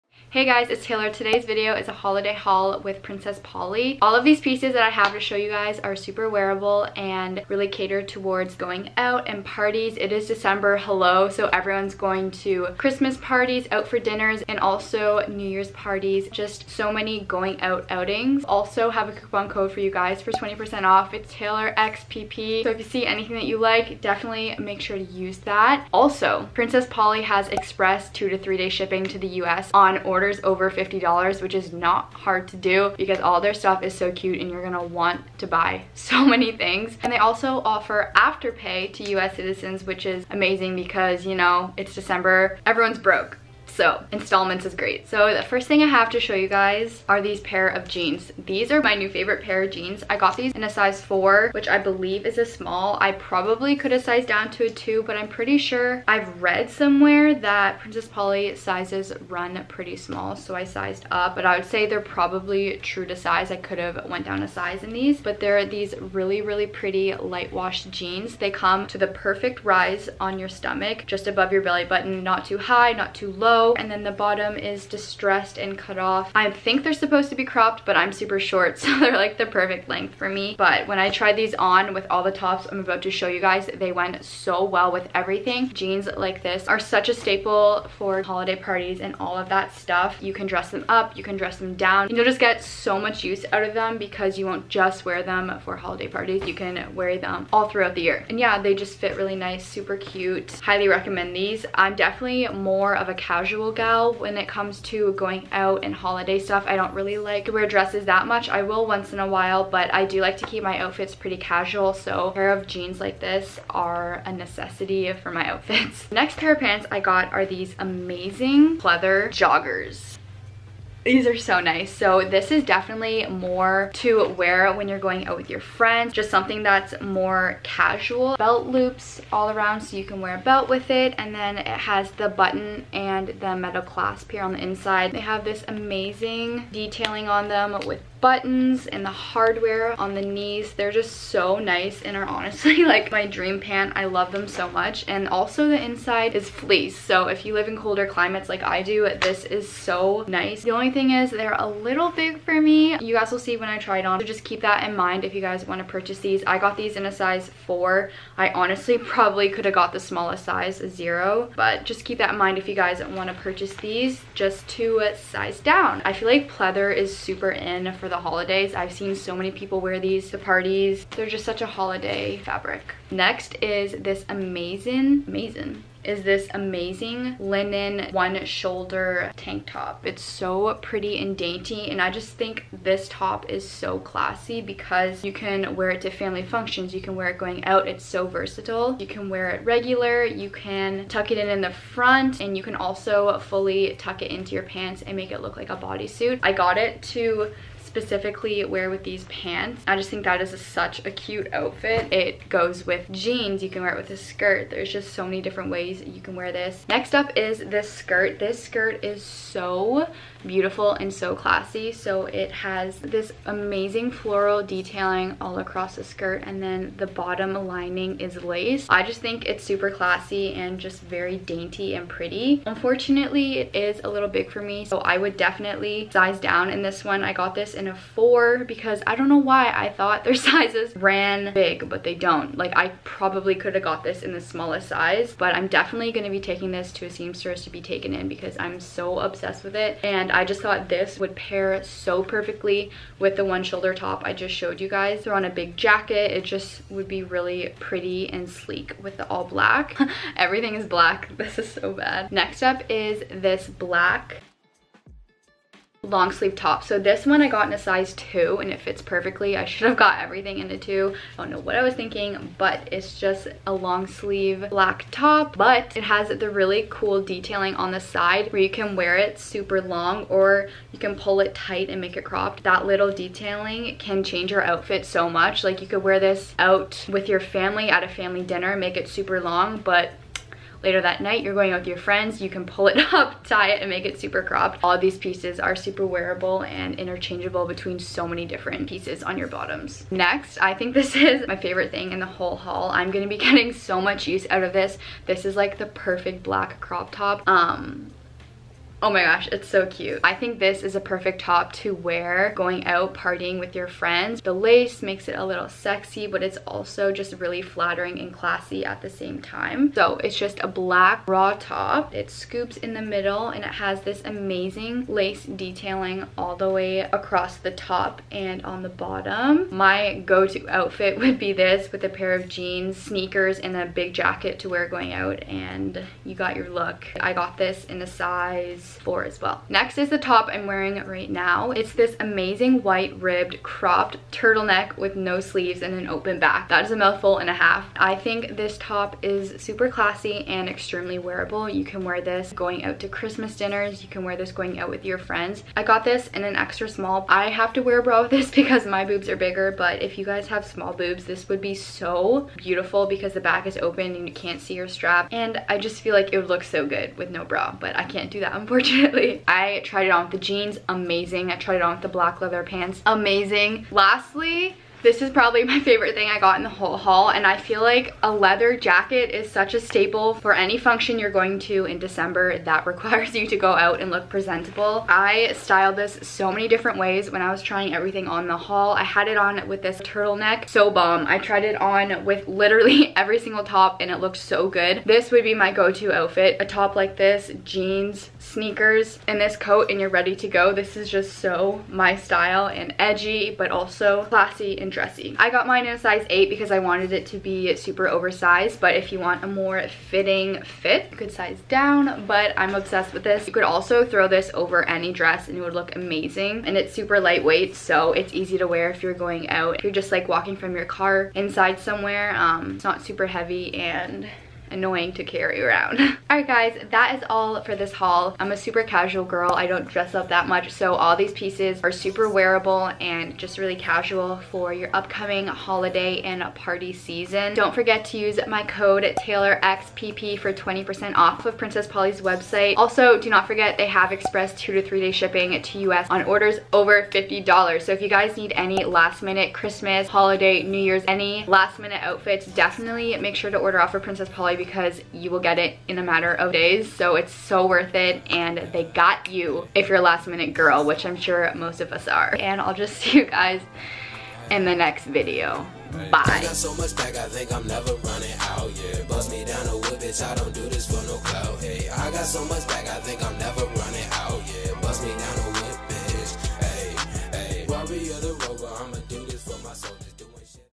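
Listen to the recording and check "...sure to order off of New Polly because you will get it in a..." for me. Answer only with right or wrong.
wrong.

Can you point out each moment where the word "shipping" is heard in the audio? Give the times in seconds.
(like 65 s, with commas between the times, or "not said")
28 s, 435 s.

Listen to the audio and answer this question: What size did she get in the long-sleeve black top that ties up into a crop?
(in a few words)
2.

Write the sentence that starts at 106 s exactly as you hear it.
I don't really like to wear dresses that much.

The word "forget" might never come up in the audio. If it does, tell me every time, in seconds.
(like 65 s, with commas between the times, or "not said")
427 s, 433 s.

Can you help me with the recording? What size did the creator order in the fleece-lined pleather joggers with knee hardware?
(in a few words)
4.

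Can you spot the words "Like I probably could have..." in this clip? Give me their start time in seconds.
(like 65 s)
232 s.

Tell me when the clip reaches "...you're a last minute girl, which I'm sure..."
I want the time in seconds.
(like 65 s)
449 s.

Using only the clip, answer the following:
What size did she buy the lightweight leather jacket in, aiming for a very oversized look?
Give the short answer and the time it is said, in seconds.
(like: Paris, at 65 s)
8, at 395 s.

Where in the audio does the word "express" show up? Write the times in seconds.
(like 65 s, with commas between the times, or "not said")
27 s, 434 s.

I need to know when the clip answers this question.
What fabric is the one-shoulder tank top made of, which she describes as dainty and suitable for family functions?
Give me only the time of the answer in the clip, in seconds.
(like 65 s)
177 s.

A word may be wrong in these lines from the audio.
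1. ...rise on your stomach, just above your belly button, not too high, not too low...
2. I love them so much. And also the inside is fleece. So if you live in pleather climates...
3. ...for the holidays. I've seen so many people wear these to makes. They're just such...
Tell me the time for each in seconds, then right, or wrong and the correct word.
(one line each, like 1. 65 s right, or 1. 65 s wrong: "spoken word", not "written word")
1. 69 s right
2. 143 s wrong: "colder", not "pleather"
3. 167 s wrong: "parties", not "makes".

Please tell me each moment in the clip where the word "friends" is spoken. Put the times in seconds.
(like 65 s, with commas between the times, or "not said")
125 s, 281 s, 303 s, 345 s.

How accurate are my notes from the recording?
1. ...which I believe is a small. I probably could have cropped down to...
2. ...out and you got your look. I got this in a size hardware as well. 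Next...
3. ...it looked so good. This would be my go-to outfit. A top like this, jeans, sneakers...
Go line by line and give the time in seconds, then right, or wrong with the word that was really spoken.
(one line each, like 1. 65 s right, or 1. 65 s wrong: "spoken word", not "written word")
1. 51 s wrong: "sized", not "cropped"
2. 325 s wrong: "explore", not "hardware"
3. 384 s right.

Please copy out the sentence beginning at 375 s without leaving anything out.
I styled this so many different ways when I was trying everything on the haul.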